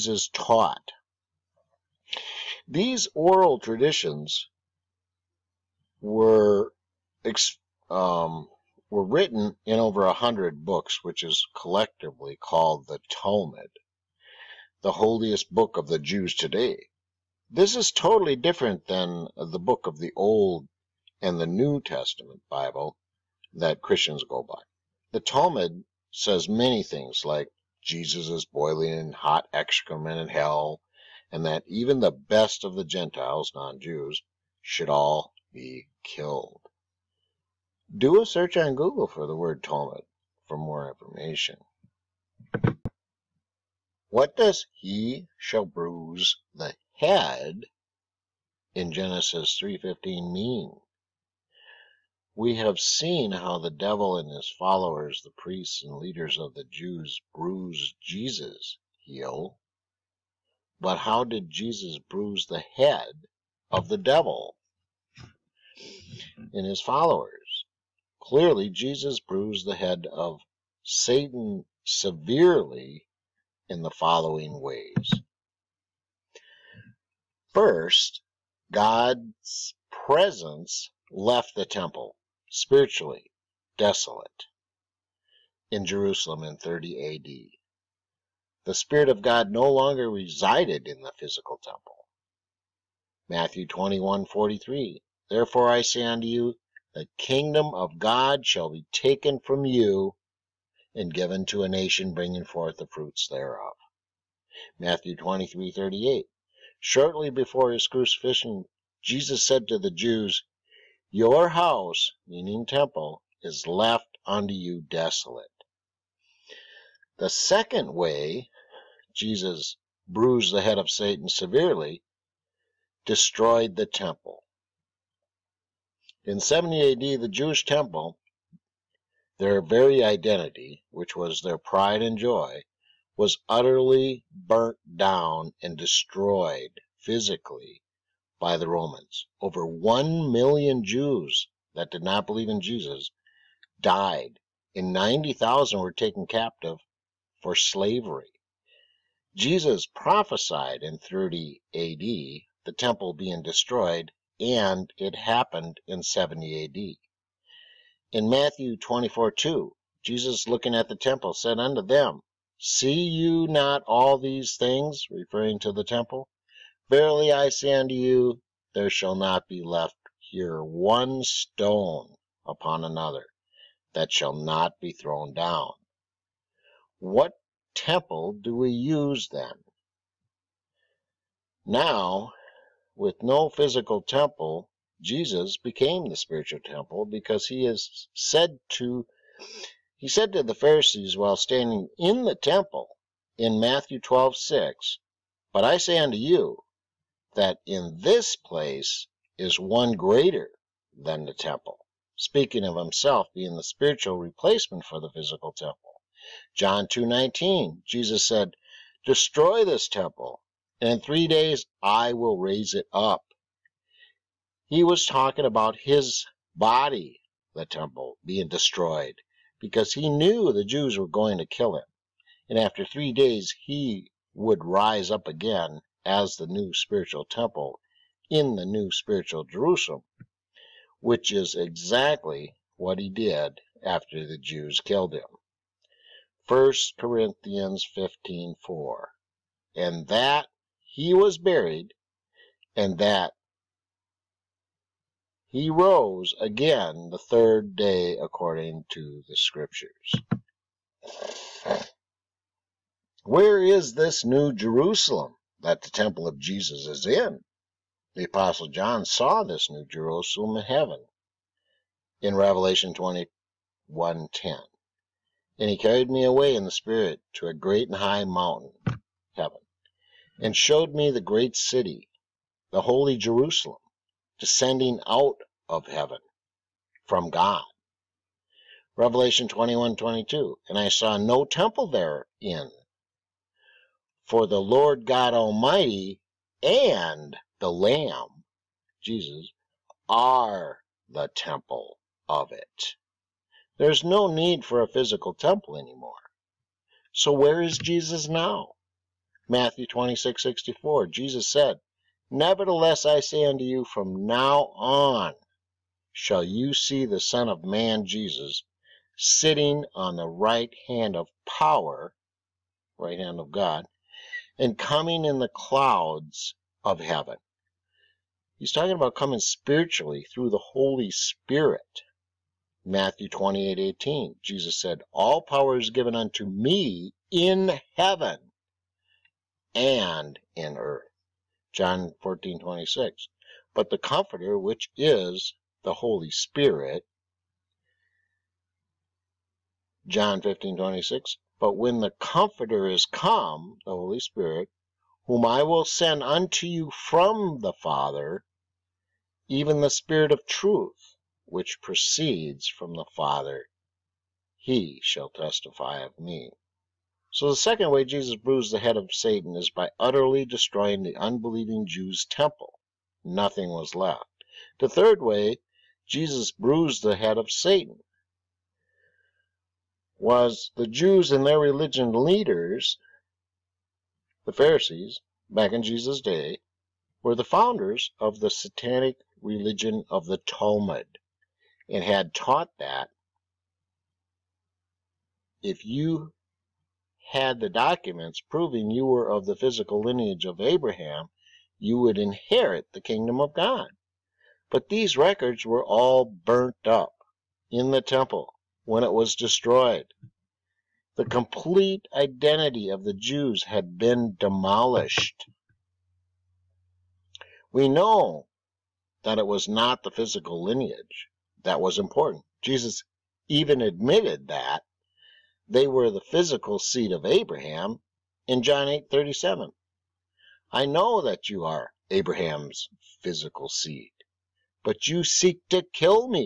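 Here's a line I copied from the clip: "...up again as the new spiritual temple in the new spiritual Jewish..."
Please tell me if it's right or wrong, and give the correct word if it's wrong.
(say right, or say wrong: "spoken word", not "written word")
wrong: "Jerusalem", not "Jewish".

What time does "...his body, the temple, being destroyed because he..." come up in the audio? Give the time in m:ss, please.
3:35.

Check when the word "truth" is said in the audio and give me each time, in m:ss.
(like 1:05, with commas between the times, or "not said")
5:50.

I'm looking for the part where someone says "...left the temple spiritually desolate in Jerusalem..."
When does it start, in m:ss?
1:21.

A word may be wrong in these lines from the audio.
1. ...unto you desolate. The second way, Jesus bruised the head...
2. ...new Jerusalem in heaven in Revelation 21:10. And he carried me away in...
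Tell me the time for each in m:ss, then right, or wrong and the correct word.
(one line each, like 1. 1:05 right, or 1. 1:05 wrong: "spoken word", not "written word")
1. 1:54 right
2. 4:19 right.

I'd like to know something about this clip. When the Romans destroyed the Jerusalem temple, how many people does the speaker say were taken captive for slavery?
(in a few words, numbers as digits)
90,000.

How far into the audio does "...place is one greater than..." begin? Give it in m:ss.
3:18.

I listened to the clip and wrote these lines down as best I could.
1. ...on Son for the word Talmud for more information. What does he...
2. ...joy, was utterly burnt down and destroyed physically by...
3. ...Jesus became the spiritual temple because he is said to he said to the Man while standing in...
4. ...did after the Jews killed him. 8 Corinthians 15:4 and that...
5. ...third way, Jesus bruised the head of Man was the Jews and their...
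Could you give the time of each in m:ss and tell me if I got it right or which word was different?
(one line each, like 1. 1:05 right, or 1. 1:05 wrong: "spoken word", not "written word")
1. 0:38 wrong: "Google", not "Son"
2. 2:12 right
3. 3:05 wrong: "Pharisees", not "Man"
4. 3:53 wrong: "1", not "8"
5. 6:04 wrong: "Satan", not "Man".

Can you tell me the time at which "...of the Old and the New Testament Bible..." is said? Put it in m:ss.
0:19.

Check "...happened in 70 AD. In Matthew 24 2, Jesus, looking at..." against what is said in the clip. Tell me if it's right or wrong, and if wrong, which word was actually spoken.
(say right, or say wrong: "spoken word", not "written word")
right.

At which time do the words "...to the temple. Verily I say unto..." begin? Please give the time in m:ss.
2:45.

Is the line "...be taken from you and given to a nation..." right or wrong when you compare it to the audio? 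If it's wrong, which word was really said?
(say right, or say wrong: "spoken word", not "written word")
right.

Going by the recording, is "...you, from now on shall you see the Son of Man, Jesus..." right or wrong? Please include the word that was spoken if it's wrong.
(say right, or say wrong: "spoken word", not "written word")
right.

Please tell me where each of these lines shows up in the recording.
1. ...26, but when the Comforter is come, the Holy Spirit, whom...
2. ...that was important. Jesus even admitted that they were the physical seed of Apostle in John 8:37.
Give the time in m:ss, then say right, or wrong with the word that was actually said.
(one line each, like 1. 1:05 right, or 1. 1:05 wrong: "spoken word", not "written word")
1. 5:40 right
2. 6:51 wrong: "Abraham", not "Apostle".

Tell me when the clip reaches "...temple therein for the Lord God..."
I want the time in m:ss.
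4:41.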